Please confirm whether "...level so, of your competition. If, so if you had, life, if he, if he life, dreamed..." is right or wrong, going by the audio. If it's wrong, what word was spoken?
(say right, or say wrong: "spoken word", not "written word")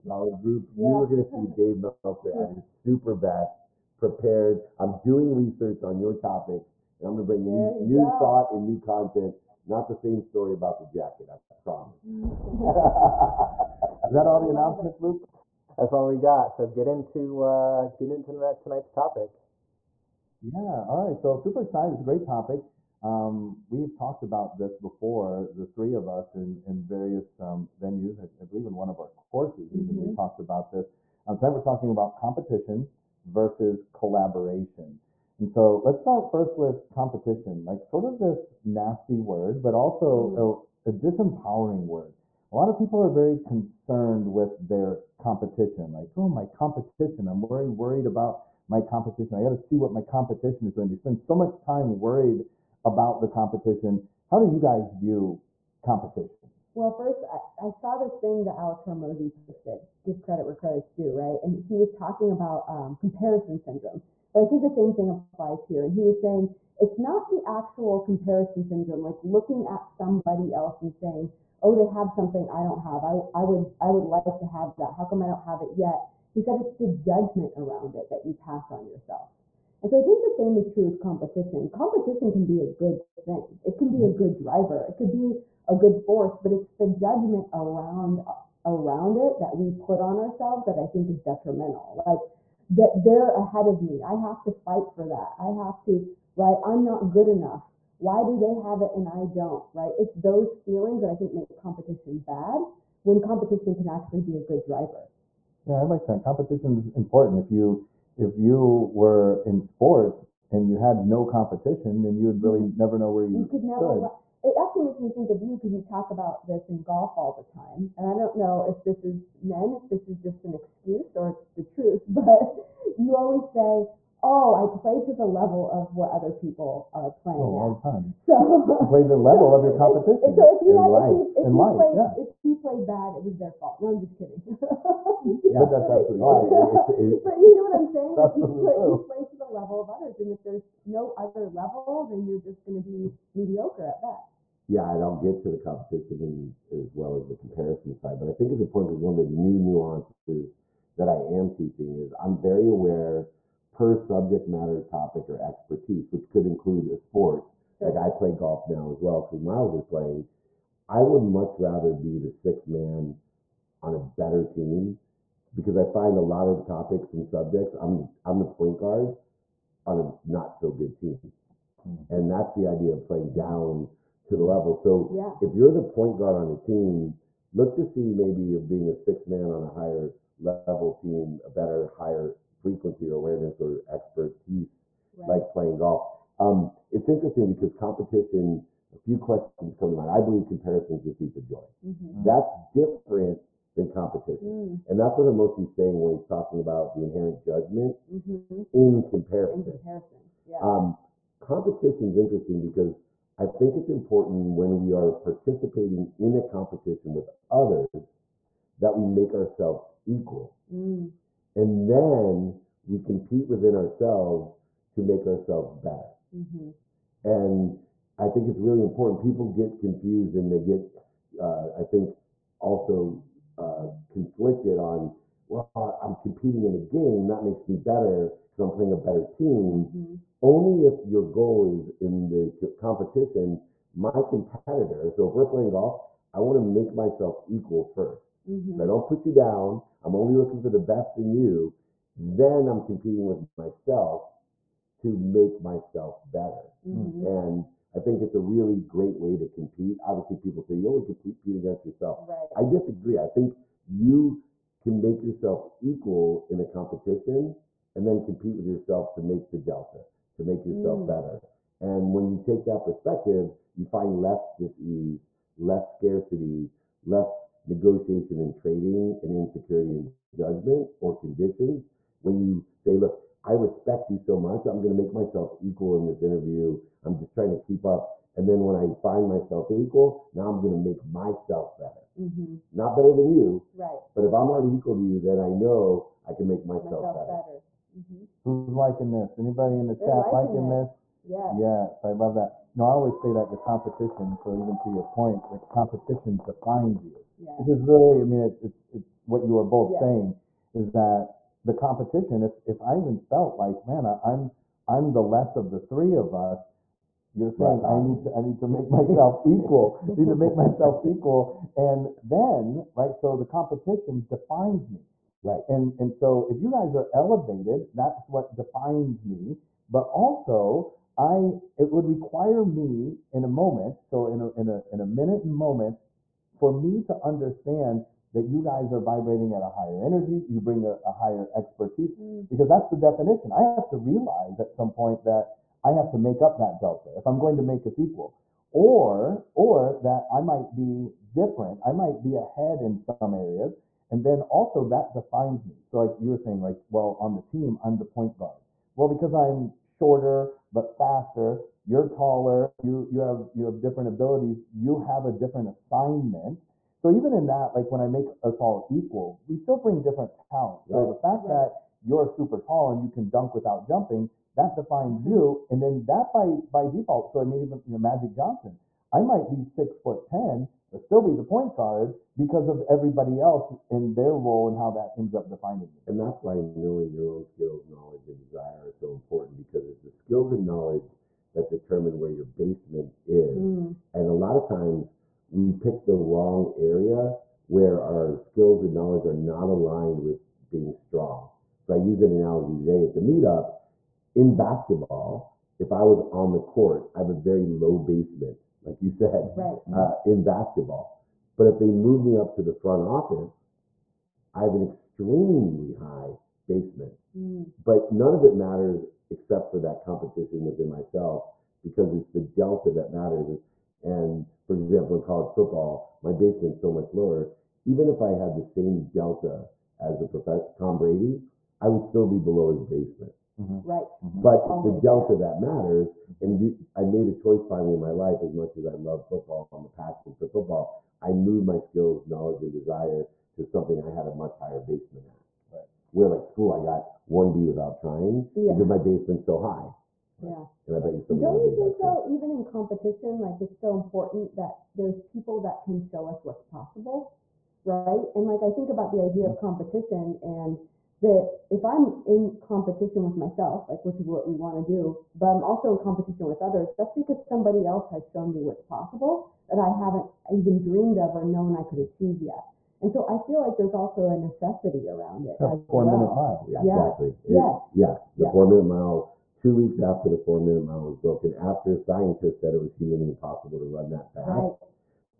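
wrong: "played", not "dreamed".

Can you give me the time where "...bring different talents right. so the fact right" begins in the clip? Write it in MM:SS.
05:59.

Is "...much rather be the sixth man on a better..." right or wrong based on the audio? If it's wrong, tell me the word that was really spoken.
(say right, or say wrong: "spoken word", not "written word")
right.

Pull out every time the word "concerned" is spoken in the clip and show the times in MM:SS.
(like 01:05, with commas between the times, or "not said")
00:43.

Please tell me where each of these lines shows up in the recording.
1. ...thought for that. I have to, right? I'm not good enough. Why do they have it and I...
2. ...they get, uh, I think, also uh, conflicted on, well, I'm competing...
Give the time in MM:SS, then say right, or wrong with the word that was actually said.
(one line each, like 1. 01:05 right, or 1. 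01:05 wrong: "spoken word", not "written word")
1. 01:34 wrong: "fight", not "thought"
2. 03:40 right.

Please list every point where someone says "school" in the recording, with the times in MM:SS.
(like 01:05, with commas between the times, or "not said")
07:16.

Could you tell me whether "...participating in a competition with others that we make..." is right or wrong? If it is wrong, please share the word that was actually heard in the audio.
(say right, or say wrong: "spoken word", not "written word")
right.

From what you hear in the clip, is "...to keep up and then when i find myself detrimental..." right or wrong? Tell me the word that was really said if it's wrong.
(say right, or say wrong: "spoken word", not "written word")
wrong: "equal", not "detrimental".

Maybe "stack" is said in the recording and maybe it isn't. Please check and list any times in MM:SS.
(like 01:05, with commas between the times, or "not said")
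not said.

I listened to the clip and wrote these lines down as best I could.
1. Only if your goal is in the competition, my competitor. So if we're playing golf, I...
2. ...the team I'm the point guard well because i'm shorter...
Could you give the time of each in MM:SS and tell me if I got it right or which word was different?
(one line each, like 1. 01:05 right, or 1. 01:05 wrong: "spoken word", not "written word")
1. 03:50 right
2. 05:47 right.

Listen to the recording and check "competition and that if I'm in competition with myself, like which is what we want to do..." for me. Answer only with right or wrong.
right.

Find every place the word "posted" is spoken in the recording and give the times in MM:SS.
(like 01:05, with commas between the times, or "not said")
00:59.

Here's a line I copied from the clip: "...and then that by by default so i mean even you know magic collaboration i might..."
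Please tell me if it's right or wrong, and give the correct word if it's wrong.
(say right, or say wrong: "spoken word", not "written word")
wrong: "johnson", not "collaboration".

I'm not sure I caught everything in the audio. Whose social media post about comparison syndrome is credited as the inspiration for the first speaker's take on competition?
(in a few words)
Alex Hormozi.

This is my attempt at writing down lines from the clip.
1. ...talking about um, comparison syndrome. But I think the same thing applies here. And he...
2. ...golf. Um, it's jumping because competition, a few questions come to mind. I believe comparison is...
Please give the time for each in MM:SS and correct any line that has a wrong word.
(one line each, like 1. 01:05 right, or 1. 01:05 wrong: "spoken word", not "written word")
1. 01:01 right
2. 03:05 wrong: "interesting", not "jumping".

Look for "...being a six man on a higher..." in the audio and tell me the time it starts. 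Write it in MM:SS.
02:58.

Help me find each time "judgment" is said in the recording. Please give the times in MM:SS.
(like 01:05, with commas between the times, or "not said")
01:16, 01:26, 03:17, 04:30.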